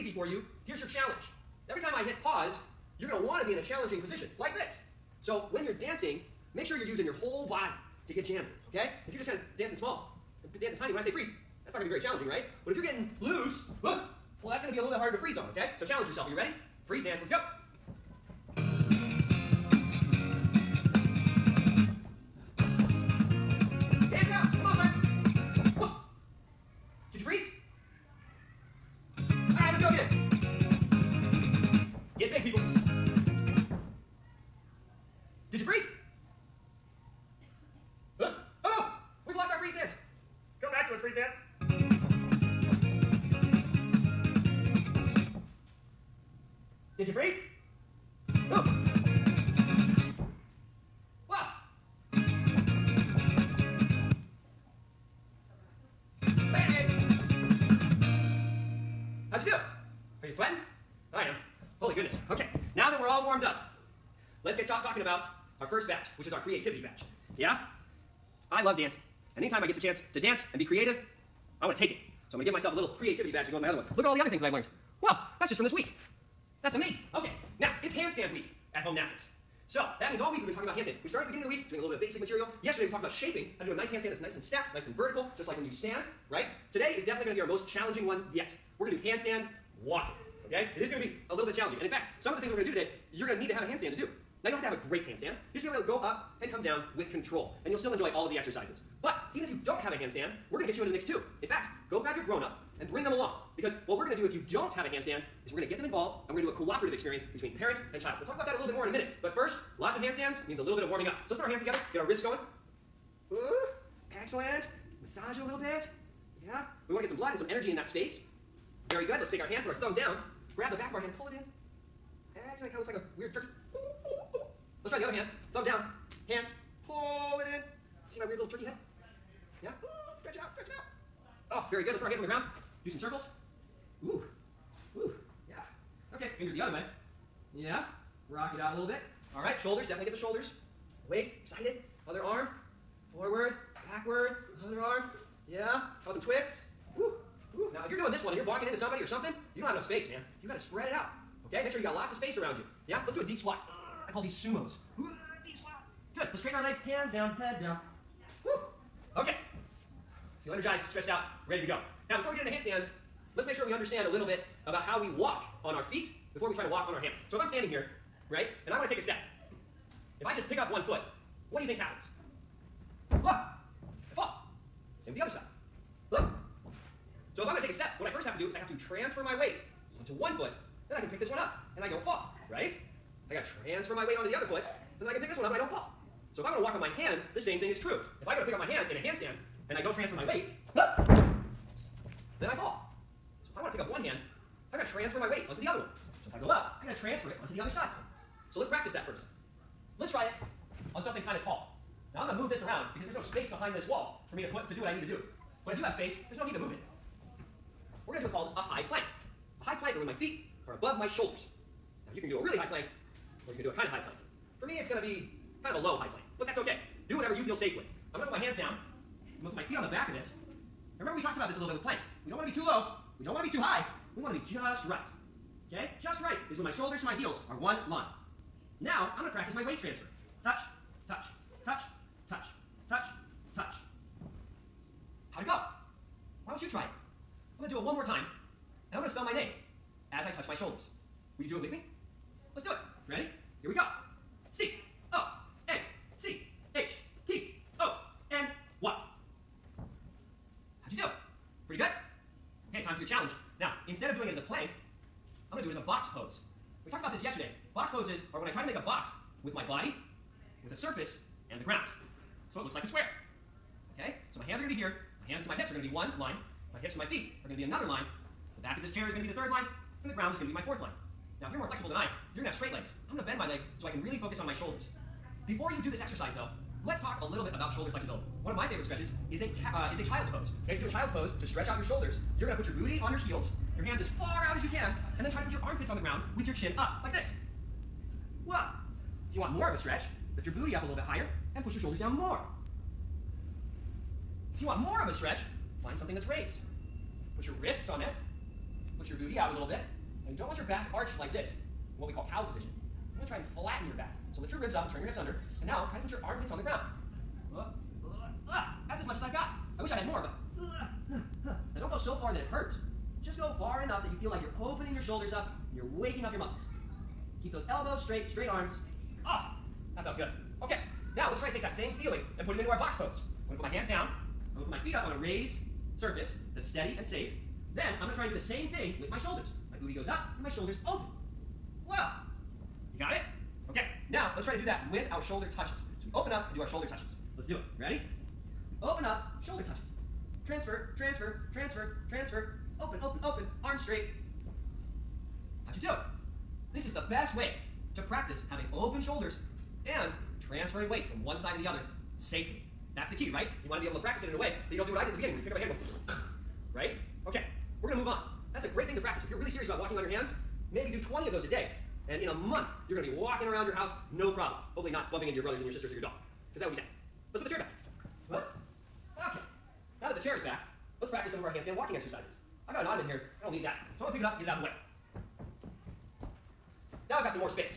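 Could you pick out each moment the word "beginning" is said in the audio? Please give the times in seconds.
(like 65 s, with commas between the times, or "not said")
81 s, 355 s.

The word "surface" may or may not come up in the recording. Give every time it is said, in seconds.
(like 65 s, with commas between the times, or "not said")
260 s, 325 s.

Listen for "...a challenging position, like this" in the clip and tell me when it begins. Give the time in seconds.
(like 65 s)
3 s.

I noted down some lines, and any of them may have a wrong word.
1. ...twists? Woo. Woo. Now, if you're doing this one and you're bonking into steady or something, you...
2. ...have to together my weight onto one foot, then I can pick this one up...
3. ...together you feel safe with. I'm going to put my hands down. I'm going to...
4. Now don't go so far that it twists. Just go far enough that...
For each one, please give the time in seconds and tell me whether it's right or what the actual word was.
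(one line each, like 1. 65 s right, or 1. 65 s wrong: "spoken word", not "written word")
1. 146 s wrong: "somebody", not "steady"
2. 178 s wrong: "transfer", not "together"
3. 217 s wrong: "whatever", not "together"
4. 311 s wrong: "hurts", not "twists".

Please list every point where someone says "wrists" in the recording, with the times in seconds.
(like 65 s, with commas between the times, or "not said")
112 s, 297 s.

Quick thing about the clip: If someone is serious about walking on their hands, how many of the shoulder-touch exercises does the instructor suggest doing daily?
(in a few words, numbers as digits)
20.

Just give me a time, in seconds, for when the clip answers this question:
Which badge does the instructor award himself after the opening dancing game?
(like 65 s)
66 s.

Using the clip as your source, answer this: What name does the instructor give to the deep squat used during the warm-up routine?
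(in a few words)
Sumos.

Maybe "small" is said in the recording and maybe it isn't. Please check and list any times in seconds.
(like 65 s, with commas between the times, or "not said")
9 s.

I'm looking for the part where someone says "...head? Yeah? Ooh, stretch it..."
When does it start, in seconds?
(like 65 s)
128 s.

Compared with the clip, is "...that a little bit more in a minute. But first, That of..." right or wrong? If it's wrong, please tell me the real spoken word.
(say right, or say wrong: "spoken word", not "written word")
wrong: "Lots", not "That".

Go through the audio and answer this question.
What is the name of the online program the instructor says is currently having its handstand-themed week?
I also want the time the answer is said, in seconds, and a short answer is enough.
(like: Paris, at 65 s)
Homenastics, at 78 s.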